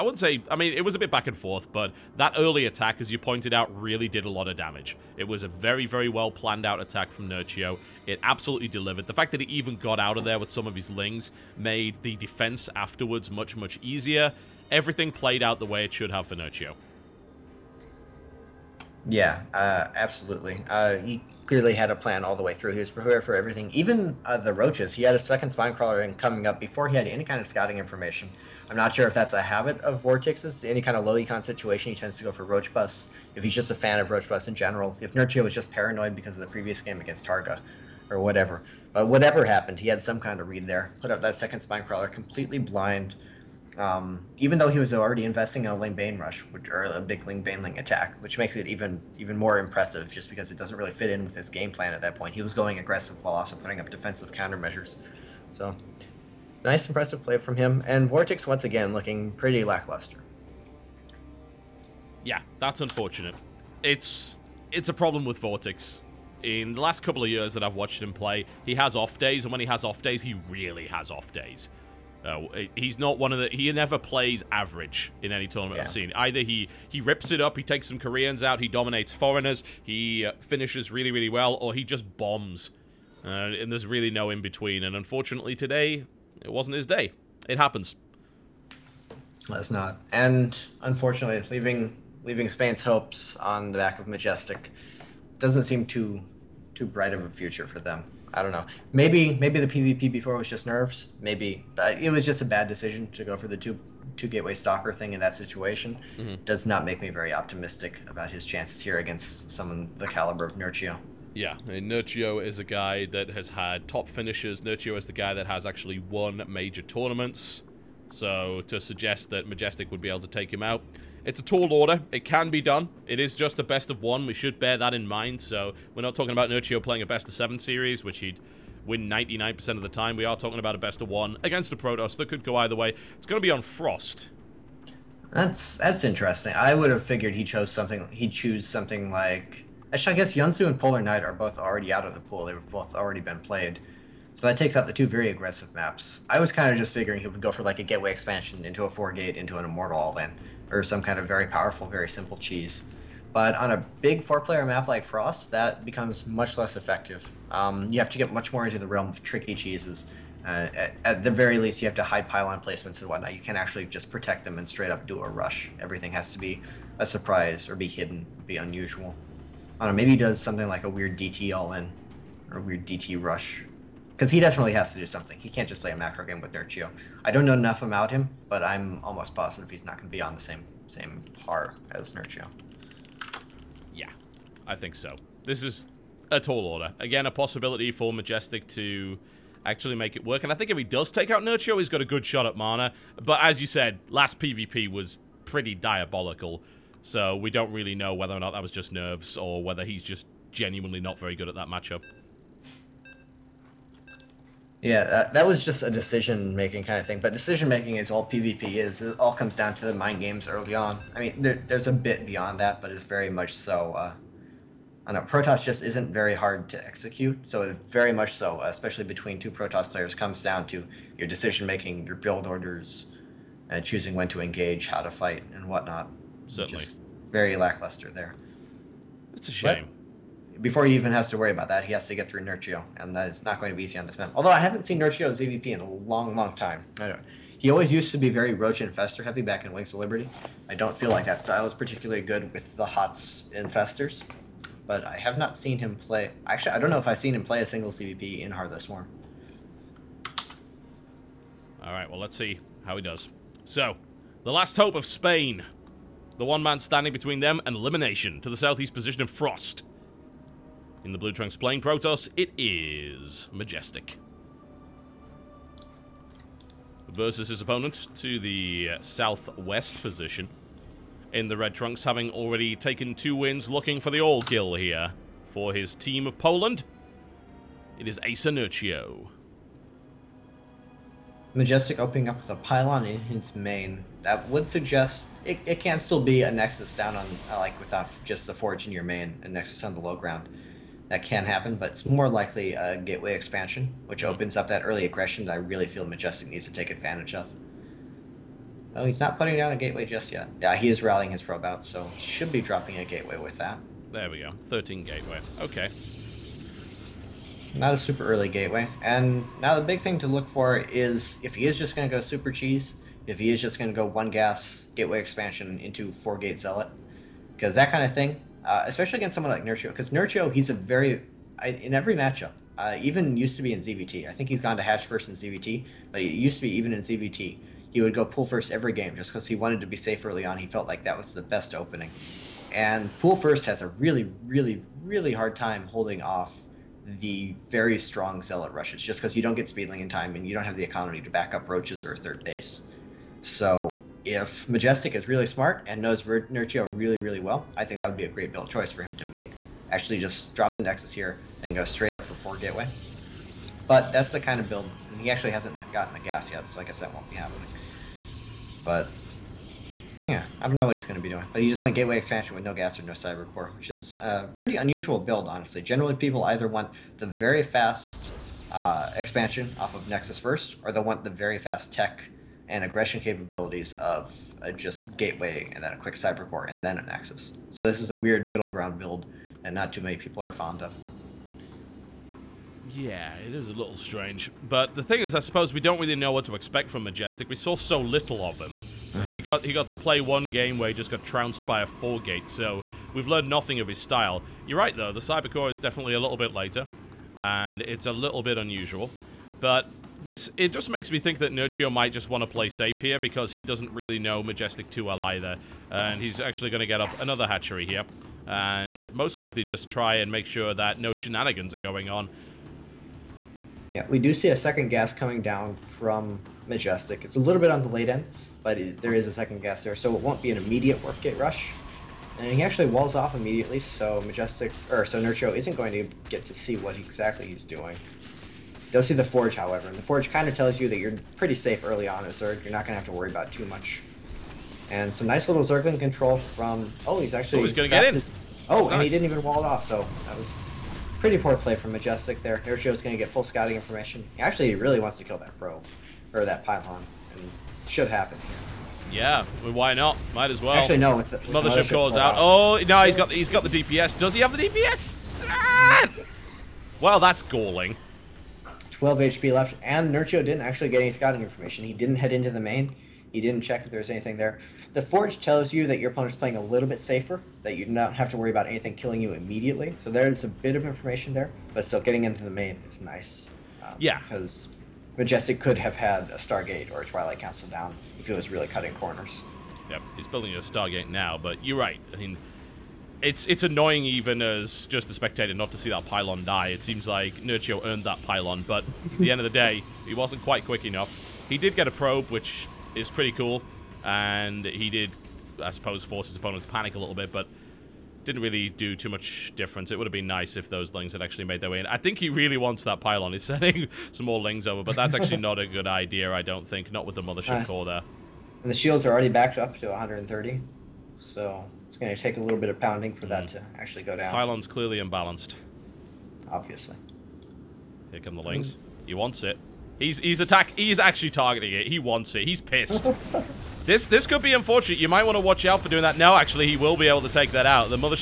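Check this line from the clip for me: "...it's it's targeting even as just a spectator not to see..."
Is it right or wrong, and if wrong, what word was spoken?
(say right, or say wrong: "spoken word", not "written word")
wrong: "annoying", not "targeting".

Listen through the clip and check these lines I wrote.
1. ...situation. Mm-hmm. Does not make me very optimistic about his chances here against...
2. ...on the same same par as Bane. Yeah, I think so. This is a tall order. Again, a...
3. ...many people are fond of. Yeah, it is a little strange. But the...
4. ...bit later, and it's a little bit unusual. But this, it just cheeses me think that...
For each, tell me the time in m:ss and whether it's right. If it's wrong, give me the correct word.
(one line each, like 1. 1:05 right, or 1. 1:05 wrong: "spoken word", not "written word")
1. 1:45 right
2. 3:00 wrong: "Nerchio", not "Bane"
3. 6:20 right
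4. 6:36 wrong: "makes", not "cheeses".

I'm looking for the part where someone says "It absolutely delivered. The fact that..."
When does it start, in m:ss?
0:08.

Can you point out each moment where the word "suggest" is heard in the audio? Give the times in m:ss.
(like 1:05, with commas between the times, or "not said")
1:58, 4:44.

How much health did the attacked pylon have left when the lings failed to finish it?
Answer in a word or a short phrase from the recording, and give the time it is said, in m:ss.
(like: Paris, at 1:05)
12 HP, at 7:38.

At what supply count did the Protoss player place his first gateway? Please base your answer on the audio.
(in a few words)
13.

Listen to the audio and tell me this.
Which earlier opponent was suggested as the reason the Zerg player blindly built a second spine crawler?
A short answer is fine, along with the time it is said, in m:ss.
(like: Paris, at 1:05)
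Targa, at 0:37.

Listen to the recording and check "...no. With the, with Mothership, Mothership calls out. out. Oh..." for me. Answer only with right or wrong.
right.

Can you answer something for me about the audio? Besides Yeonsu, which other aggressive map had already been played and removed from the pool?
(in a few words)
Polar Night.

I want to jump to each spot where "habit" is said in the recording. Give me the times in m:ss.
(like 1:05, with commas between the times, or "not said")
0:29.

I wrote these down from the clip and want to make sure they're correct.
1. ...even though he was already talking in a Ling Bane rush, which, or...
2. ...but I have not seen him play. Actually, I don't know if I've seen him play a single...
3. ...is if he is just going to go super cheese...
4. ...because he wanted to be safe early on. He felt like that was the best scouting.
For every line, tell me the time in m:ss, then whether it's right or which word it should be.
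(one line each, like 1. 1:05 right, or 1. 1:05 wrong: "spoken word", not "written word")
1. 0:44 wrong: "investing", not "talking"
2. 4:04 right
3. 5:10 right
4. 5:29 wrong: "opening", not "scouting".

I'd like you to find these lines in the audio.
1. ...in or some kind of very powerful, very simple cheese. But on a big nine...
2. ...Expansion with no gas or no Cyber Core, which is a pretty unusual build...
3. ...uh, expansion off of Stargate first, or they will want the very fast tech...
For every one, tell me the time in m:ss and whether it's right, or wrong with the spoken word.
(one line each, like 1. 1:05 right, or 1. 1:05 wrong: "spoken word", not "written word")
1. 2:30 wrong: "four", not "nine"
2. 6:02 right
3. 6:08 wrong: "Nexus", not "Stargate".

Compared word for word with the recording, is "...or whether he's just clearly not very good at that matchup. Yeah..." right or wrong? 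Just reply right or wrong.
wrong.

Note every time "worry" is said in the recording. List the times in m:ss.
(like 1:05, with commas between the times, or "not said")
3:51, 7:13, 7:48.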